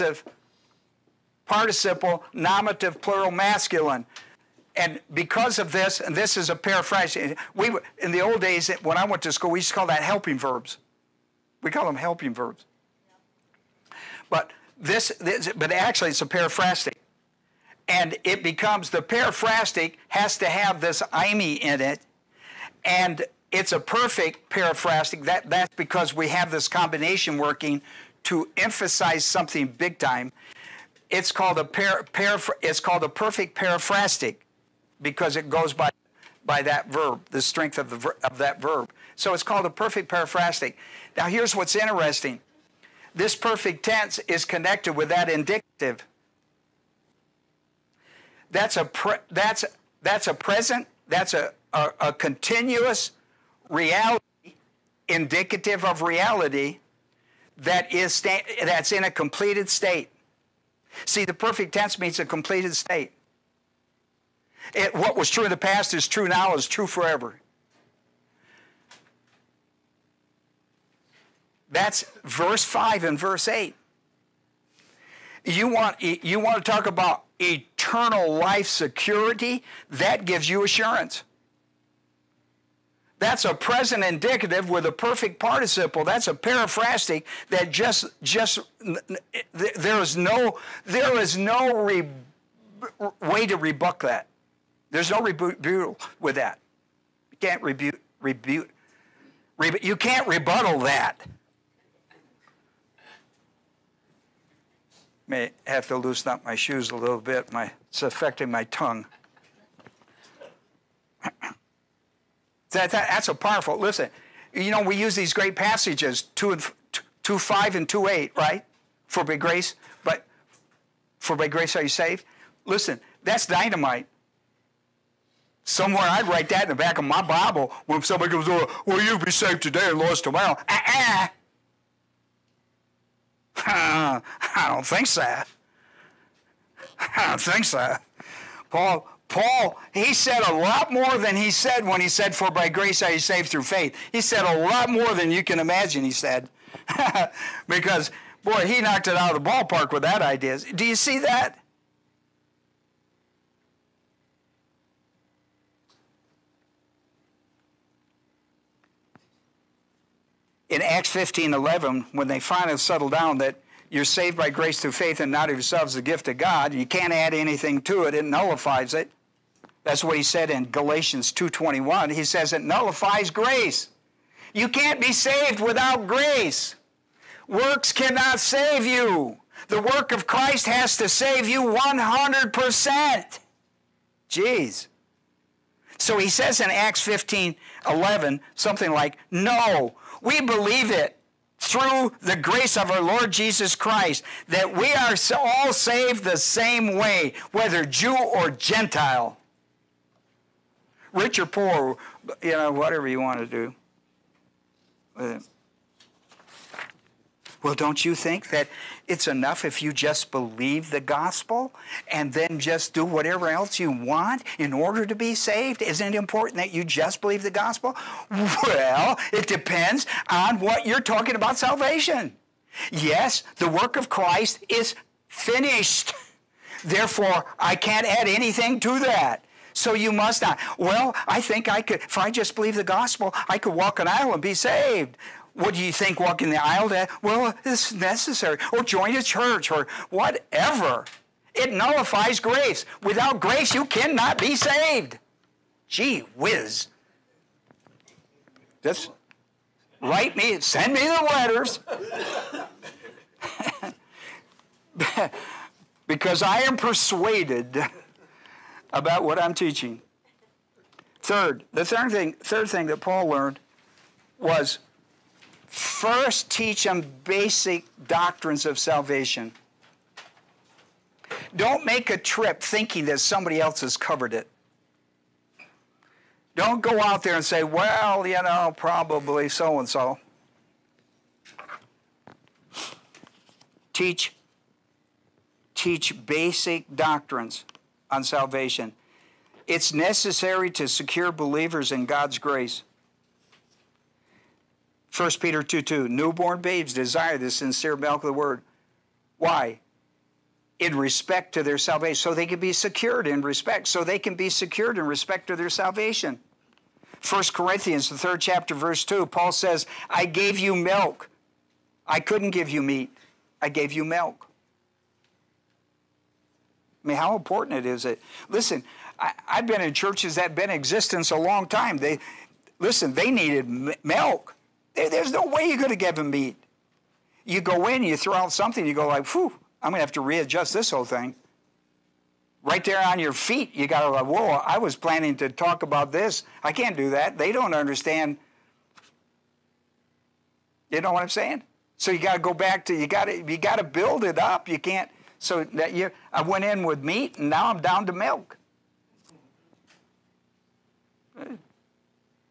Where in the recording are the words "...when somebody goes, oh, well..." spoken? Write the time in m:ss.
2:07.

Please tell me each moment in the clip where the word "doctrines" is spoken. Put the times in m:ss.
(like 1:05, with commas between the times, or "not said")
4:28, 4:46.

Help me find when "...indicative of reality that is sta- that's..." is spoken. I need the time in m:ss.
0:55.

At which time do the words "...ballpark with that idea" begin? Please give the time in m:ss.
2:29.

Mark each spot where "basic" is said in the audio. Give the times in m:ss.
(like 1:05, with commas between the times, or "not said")
4:27, 4:46.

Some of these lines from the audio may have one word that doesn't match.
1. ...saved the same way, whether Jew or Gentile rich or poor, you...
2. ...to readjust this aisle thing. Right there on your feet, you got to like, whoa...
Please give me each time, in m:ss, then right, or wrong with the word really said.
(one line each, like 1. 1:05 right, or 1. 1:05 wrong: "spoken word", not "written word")
1. 3:15 right
2. 5:30 wrong: "whole", not "aisle".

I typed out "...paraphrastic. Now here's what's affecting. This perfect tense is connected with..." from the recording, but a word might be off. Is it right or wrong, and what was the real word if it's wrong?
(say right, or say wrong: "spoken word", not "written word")
wrong: "interesting", not "affecting".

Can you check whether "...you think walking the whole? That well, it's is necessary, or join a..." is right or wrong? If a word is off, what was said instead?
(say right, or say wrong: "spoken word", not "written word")
wrong: "aisle", not "whole".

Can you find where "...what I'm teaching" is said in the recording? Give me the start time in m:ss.
4:19.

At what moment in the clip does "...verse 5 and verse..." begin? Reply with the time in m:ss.
1:12.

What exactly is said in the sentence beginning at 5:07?
1 Corinthians, the third chapter, verse 2, Paul says, I gave you milk.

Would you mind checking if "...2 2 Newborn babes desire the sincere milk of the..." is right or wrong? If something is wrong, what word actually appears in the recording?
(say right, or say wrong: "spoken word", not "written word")
right.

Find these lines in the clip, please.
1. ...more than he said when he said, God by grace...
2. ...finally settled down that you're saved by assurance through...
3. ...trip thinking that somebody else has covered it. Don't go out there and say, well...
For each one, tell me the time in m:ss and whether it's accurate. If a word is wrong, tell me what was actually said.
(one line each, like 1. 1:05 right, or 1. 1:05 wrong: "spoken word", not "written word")
1. 2:20 wrong: "For", not "God"
2. 2:42 wrong: "grace", not "assurance"
3. 4:32 right.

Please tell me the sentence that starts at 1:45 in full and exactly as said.
May have to loosen up my shoes a little bit.